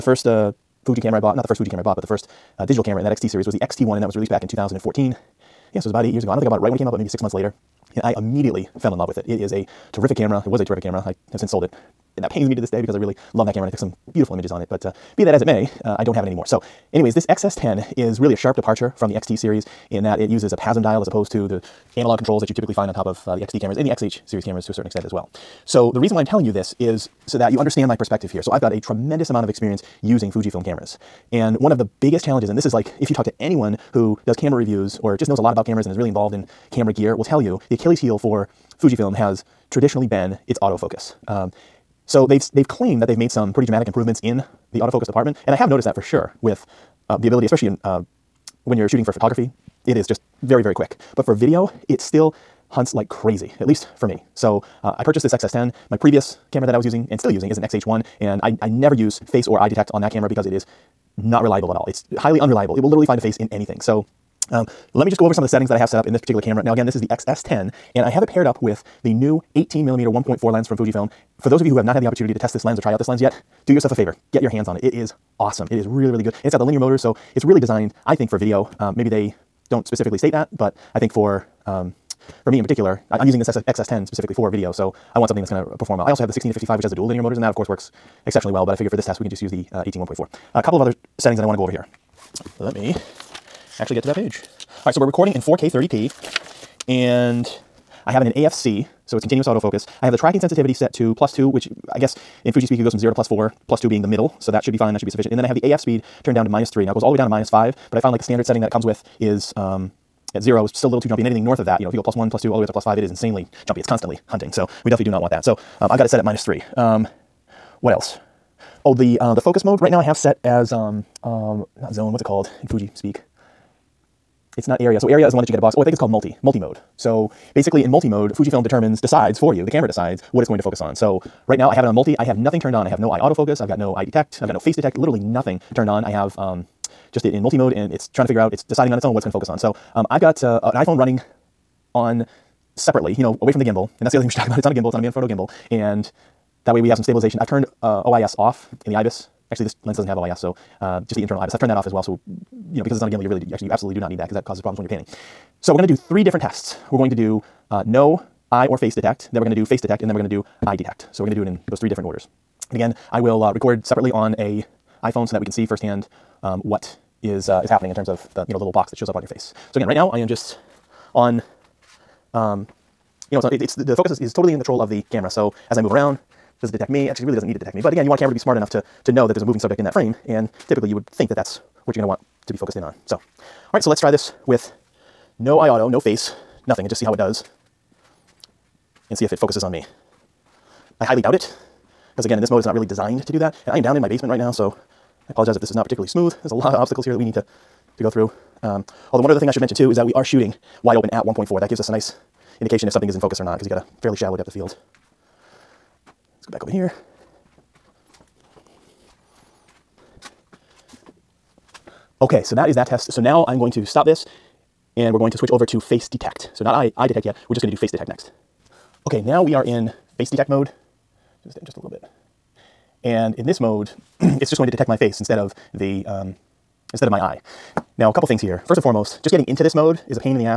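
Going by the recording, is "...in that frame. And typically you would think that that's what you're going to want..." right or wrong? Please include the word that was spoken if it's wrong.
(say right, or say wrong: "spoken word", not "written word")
right.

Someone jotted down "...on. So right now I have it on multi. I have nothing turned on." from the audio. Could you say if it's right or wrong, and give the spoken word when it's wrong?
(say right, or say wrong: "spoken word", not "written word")
right.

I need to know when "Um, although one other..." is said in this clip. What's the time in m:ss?
3:18.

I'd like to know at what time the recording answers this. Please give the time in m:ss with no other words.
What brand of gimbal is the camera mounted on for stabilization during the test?
2:25.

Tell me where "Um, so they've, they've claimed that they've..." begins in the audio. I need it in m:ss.
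0:41.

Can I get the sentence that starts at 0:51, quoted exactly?
But for video, it still hunts like crazy, at least for me.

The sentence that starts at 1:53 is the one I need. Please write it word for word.
It's constantly hunting, so we definitely do not want that.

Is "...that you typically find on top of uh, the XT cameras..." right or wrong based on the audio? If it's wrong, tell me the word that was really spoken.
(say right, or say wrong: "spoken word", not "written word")
right.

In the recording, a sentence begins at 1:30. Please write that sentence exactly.
A couple of other settings that I want to go over here.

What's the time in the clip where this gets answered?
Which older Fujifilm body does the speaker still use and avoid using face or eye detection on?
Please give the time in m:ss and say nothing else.
0:57.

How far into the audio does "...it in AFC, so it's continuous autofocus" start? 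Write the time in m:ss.
1:38.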